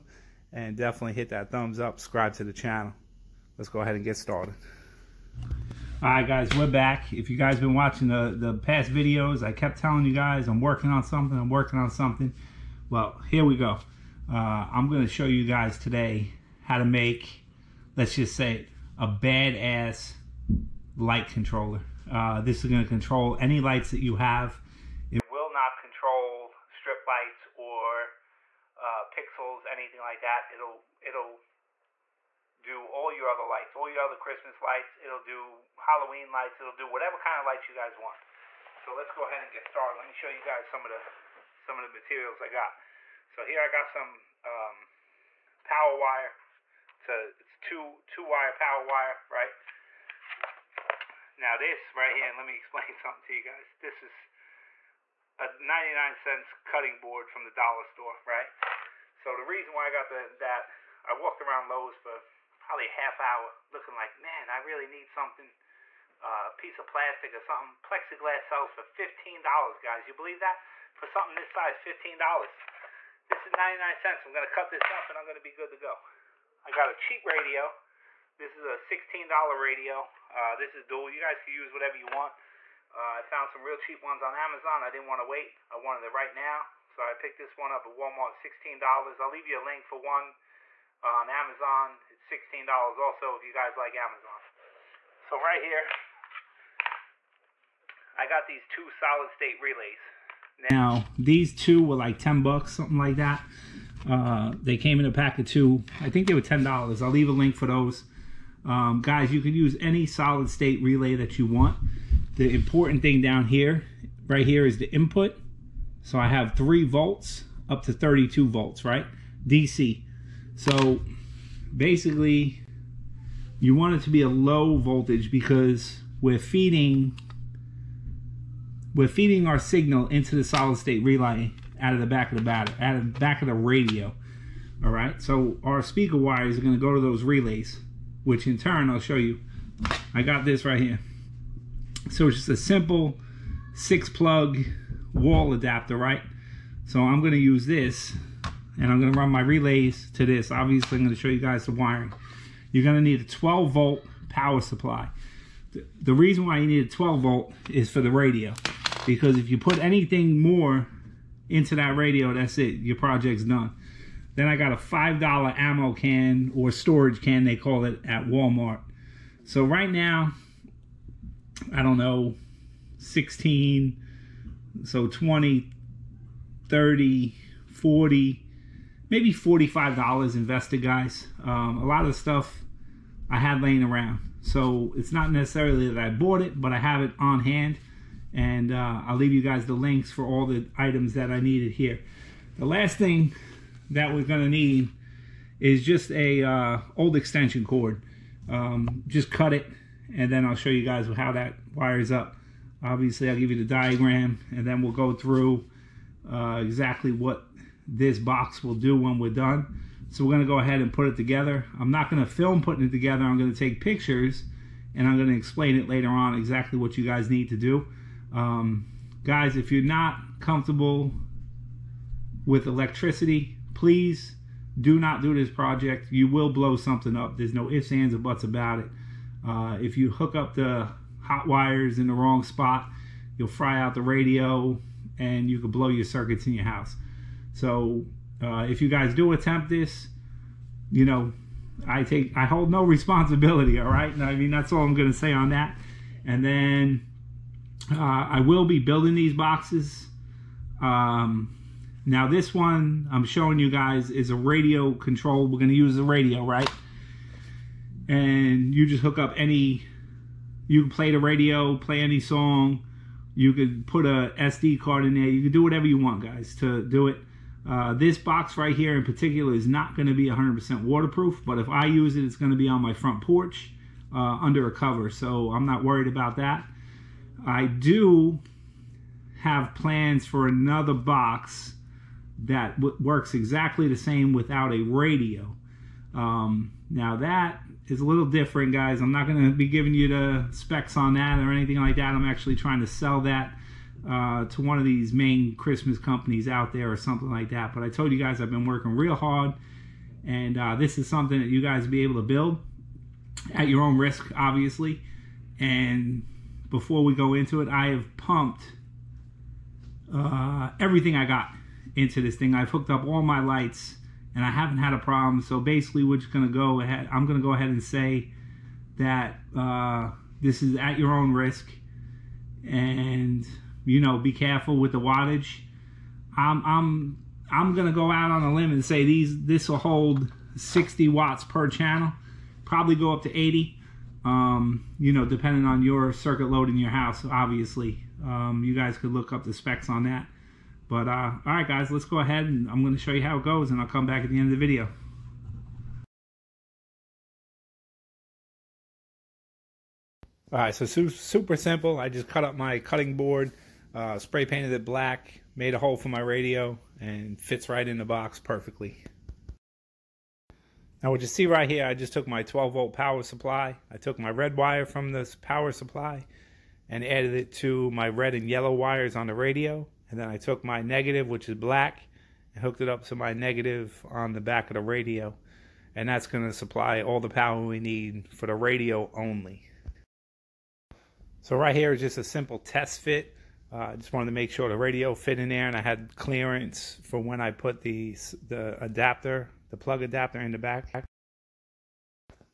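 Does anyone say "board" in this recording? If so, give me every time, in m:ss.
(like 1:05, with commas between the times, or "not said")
0:56, 5:53.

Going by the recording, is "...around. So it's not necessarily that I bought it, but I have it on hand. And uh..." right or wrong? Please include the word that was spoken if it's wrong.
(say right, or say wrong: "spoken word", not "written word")
right.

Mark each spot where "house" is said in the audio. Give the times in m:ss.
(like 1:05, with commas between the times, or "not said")
3:56, 5:36.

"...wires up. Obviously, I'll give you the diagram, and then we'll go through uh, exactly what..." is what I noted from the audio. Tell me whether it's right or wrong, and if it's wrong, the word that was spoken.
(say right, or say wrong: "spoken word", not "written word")
right.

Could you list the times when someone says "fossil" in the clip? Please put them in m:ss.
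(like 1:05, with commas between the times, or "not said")
not said.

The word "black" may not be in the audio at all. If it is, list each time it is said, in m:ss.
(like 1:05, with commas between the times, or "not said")
5:54, 6:11.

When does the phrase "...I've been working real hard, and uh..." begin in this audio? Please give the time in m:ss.
4:58.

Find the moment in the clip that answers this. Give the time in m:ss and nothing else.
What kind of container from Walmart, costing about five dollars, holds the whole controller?
2:45.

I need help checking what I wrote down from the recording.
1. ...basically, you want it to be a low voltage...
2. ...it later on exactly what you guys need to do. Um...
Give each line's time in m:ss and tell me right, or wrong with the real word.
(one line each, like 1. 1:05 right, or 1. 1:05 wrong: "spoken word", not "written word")
1. 2:01 right
2. 3:35 right.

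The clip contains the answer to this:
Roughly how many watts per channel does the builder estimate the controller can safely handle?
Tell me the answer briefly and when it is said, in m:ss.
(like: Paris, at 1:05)
60 watts, at 5:30.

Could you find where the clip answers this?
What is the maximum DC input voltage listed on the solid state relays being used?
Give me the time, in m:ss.
1:57.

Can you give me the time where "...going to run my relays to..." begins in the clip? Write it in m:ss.
2:29.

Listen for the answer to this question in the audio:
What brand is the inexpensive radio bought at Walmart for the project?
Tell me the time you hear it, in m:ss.
1:20.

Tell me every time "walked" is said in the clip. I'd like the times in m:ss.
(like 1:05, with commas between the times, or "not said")
1:01.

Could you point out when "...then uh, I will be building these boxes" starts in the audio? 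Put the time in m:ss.
4:06.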